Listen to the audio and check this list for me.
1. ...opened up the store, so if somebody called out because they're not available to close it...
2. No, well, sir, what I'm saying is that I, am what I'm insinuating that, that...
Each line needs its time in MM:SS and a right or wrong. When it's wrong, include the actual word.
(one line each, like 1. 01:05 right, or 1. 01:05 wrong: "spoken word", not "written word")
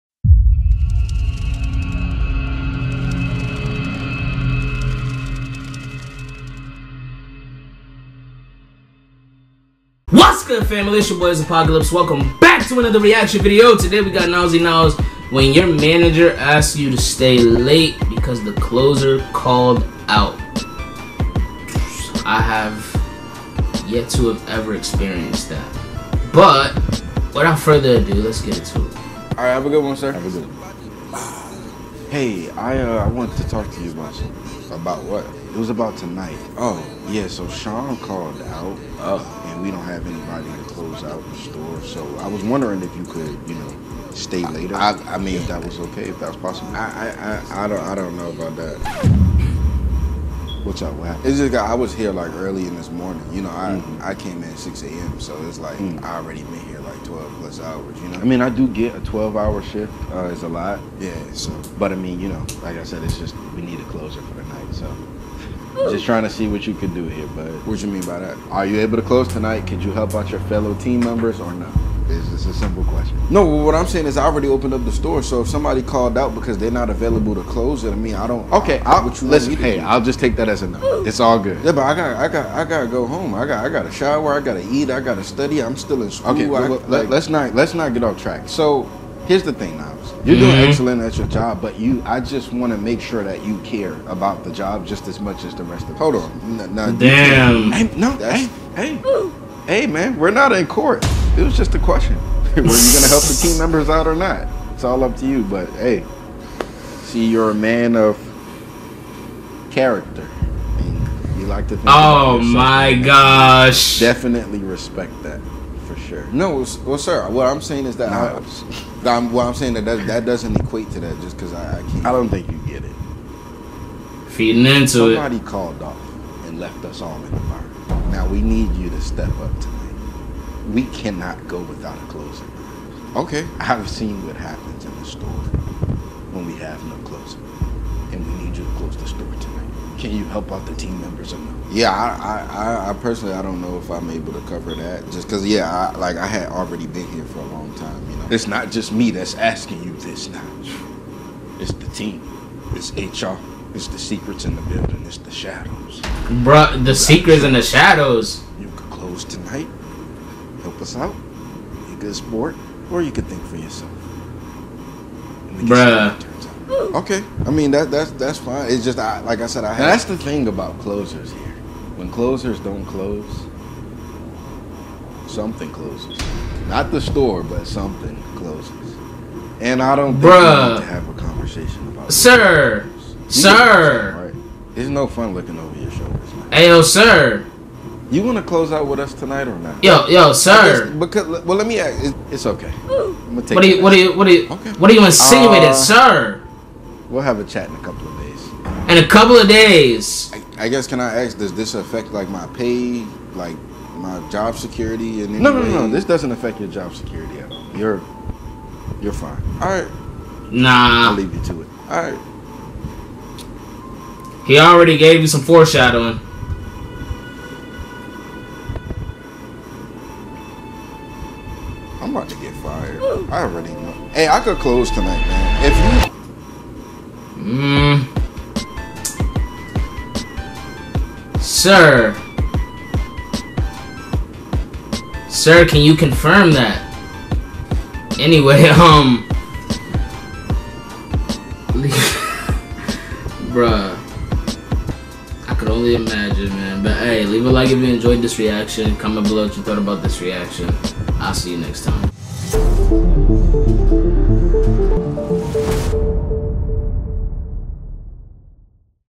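1. 01:14 right
2. 01:56 wrong: "saying", not "insinuating".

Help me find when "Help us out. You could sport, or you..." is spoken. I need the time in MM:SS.
02:40.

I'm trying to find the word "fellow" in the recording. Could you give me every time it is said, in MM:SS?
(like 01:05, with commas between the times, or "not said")
01:10.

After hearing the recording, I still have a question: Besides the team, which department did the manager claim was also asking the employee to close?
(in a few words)
HR.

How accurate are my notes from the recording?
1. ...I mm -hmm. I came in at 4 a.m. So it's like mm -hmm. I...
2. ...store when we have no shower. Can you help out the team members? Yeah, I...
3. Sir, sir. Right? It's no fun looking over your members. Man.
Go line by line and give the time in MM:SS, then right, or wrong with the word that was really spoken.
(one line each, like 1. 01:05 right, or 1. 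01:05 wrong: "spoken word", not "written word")
1. 00:53 wrong: "6", not "4"
2. 02:15 wrong: "closer", not "shower"
3. 03:02 wrong: "shoulders", not "members".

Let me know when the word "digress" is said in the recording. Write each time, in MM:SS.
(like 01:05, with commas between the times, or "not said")
not said.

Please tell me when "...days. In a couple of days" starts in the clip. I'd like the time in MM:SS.
03:18.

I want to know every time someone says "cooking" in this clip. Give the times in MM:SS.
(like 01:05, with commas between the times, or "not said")
not said.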